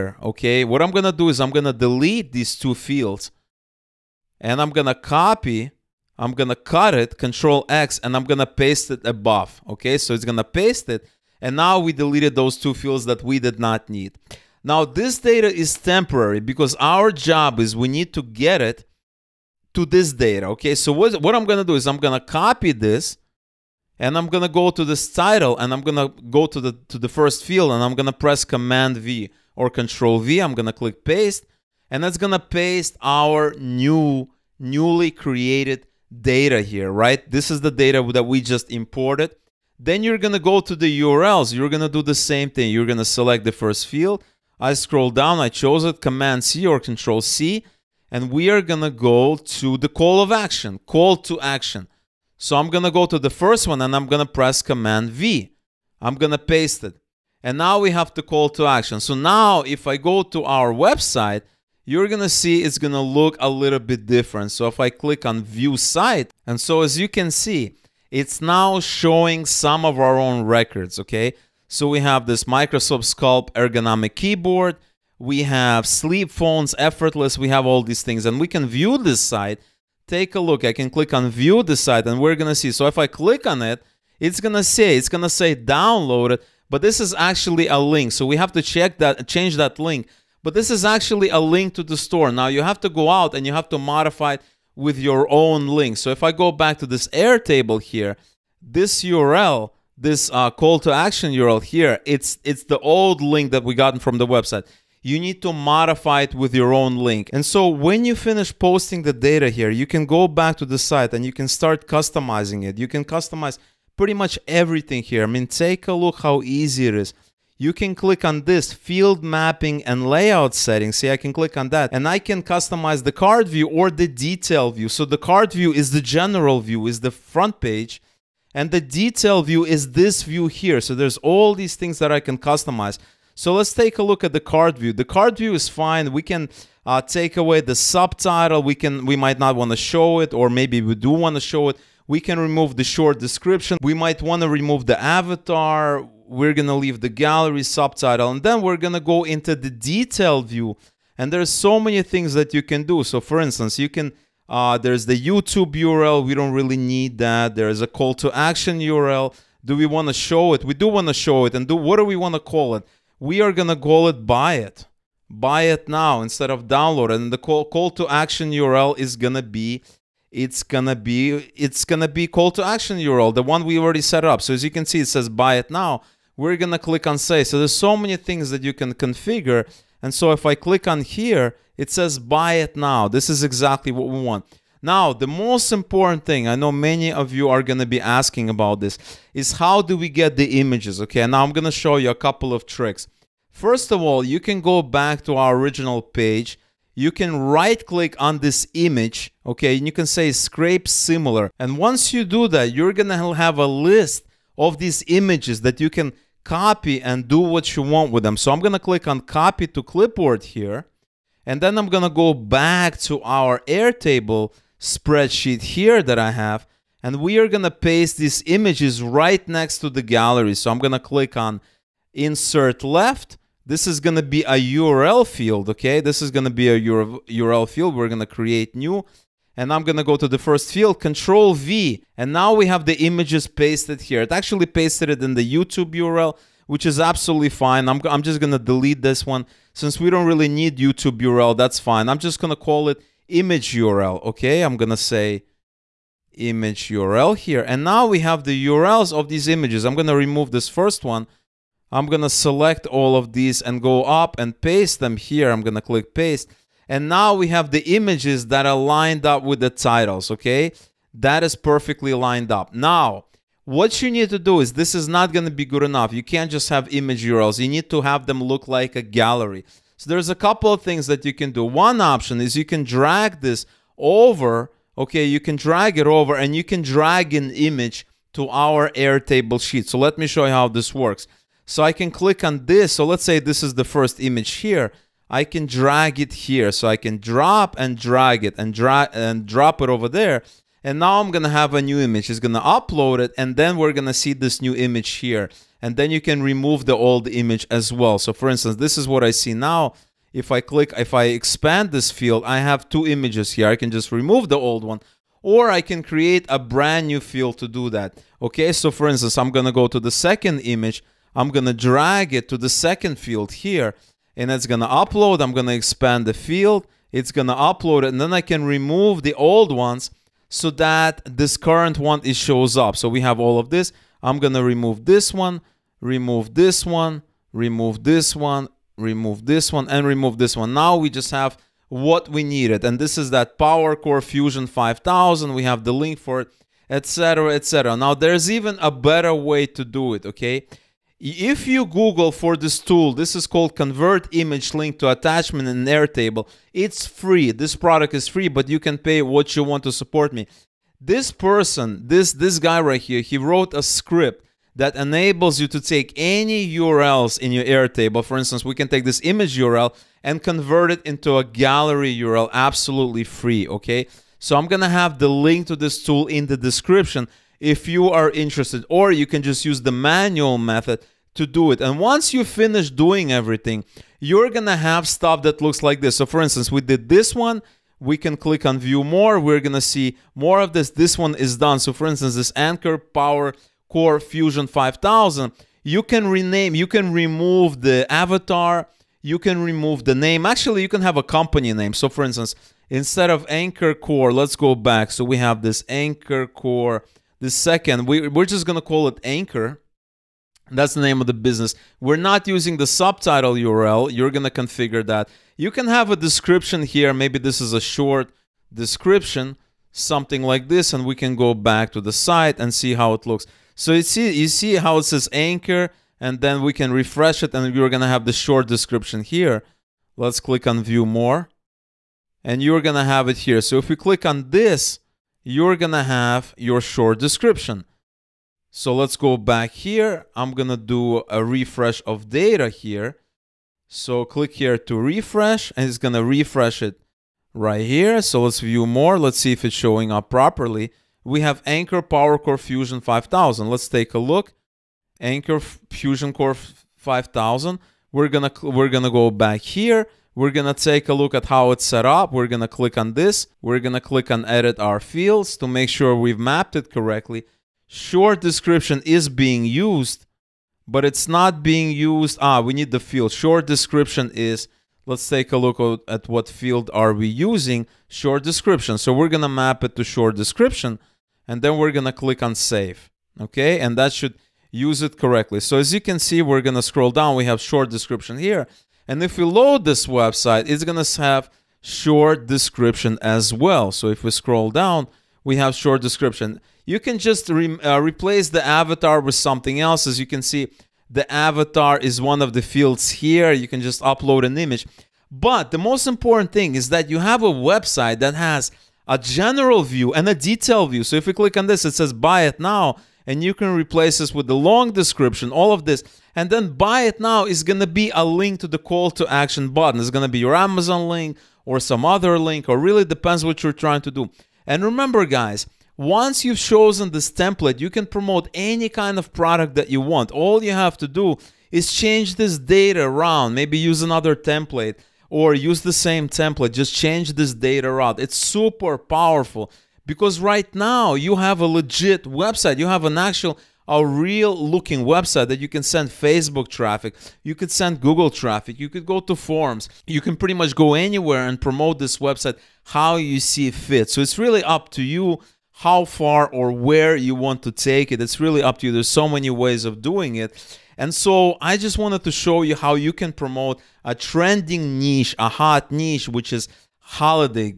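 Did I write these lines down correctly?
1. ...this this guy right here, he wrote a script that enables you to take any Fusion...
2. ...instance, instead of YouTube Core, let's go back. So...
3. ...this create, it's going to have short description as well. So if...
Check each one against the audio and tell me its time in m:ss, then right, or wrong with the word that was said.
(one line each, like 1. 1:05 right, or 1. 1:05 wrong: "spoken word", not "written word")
1. 5:52 wrong: "URLs", not "Fusion"
2. 6:32 wrong: "Anker", not "YouTube"
3. 7:59 wrong: "website", not "create".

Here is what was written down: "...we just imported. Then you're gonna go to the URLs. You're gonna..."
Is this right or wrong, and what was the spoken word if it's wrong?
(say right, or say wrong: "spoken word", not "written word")
right.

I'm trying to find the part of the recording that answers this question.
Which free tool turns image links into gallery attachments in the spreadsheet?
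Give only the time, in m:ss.
5:43.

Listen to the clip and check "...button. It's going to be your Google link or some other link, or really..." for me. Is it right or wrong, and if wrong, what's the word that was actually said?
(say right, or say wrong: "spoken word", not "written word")
wrong: "Amazon", not "Google".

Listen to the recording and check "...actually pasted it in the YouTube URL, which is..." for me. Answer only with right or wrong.
right.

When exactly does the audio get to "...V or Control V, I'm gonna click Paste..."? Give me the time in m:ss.
0:28.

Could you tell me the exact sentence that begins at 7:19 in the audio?
Let's see if it's showing up properly.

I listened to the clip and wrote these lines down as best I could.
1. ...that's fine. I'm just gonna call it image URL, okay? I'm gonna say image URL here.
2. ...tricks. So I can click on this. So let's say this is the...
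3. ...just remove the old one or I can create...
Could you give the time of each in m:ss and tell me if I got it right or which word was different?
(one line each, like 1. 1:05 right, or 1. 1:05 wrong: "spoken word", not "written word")
1. 4:01 right
2. 4:40 wrong: "works", not "tricks"
3. 5:03 right.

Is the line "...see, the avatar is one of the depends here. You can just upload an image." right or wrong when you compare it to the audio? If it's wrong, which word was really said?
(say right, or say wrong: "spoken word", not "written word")
wrong: "fields", not "depends".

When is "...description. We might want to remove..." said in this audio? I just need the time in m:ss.
2:23.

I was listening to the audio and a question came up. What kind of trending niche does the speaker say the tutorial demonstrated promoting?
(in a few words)
Holiday.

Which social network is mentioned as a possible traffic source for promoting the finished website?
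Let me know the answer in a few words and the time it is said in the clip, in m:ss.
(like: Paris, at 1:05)
Facebook, at 8:56.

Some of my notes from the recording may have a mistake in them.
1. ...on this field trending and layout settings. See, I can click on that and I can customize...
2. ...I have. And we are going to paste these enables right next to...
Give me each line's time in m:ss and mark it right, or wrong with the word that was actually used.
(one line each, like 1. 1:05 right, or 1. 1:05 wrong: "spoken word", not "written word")
1. 1:58 wrong: "mapping", not "trending"
2. 3:36 wrong: "images", not "enables".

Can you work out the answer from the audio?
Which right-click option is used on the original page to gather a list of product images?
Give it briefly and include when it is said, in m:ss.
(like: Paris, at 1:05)
Scrape similar, at 3:20.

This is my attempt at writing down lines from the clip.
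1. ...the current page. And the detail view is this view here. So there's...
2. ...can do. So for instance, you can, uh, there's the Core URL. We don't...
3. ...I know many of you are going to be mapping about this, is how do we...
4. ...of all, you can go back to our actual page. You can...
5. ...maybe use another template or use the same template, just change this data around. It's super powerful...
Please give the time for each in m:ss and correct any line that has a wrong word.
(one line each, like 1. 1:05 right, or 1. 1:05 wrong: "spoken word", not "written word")
1. 2:07 wrong: "front", not "current"
2. 2:32 wrong: "YouTube", not "Core"
3. 3:06 wrong: "asking", not "mapping"
4. 3:13 wrong: "original", not "actual"
5. 8:43 right.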